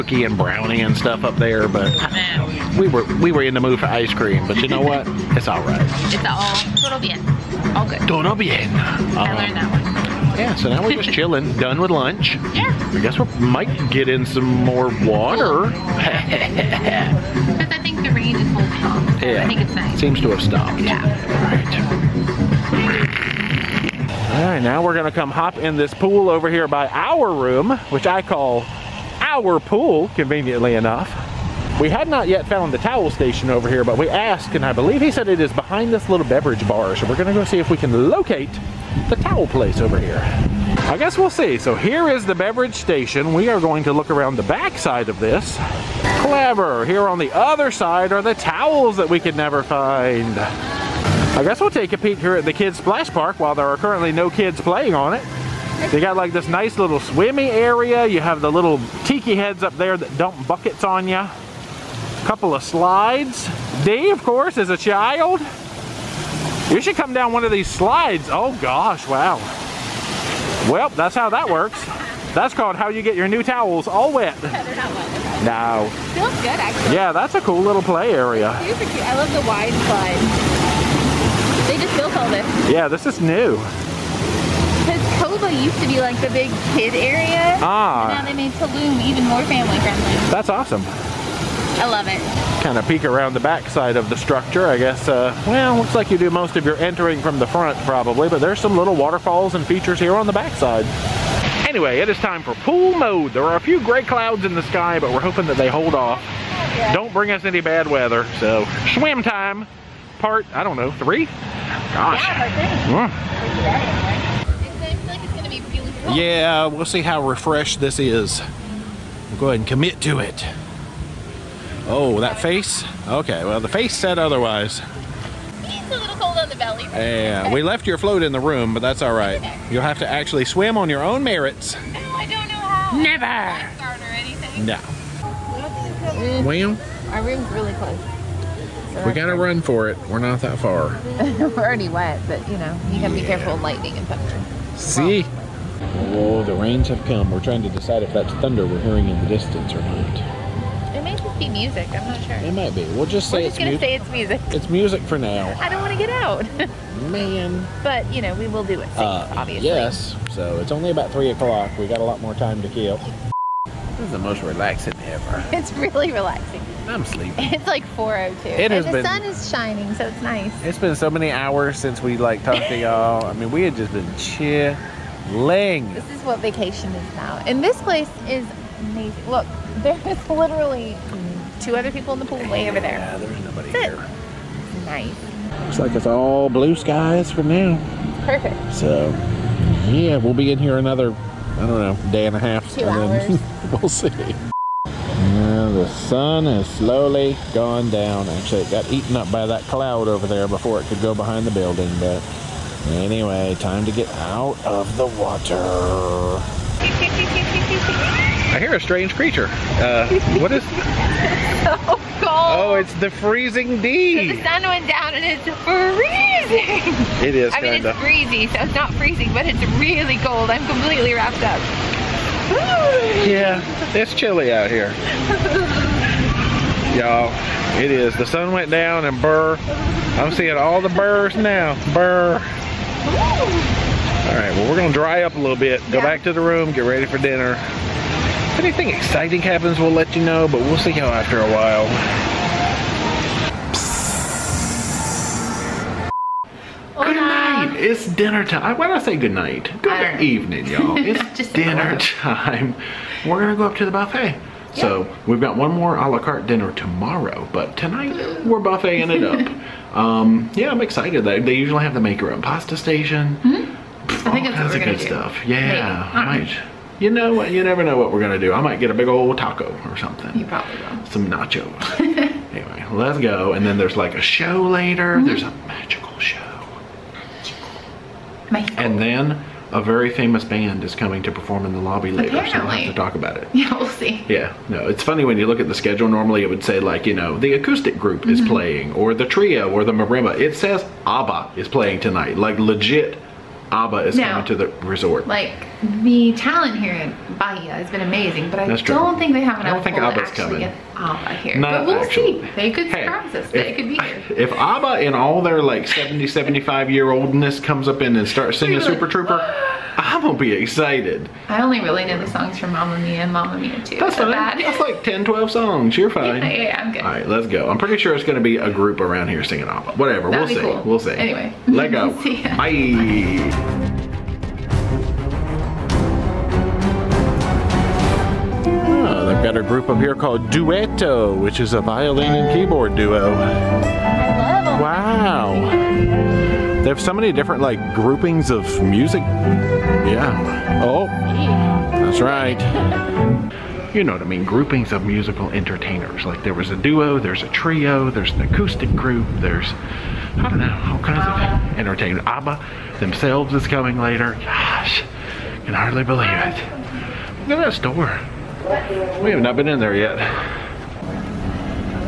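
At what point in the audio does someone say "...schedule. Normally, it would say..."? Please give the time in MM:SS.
04:45.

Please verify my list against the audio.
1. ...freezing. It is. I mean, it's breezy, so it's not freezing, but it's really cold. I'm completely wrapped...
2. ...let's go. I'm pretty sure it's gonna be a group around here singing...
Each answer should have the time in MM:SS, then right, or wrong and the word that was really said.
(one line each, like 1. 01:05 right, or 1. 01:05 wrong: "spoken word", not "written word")
1. 03:35 right
2. 05:17 right.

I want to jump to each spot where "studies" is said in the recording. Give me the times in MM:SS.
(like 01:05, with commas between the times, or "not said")
not said.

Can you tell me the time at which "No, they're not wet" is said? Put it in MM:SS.
01:14.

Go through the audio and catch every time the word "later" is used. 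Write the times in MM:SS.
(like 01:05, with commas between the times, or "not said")
04:34, 04:42, 05:53.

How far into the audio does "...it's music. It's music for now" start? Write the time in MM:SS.
02:33.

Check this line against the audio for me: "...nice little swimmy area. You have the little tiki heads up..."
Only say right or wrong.
right.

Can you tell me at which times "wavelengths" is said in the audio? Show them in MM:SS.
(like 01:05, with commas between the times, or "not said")
not said.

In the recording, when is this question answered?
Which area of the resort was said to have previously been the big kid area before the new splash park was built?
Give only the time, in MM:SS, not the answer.
01:25.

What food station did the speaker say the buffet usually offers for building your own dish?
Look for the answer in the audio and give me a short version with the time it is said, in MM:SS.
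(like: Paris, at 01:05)
Make your own pasta, at 04:21.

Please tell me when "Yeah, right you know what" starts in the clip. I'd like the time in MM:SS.
04:25.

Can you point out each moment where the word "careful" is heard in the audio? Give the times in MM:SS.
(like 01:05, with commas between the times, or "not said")
02:23.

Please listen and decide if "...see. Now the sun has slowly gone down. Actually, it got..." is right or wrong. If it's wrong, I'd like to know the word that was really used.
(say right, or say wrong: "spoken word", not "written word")
right.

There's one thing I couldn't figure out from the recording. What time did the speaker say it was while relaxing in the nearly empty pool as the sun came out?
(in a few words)
4:02.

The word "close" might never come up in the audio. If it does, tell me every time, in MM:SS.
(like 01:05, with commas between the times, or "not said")
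02:17.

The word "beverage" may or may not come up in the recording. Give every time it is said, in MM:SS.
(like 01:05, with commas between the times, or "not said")
00:36, 00:42.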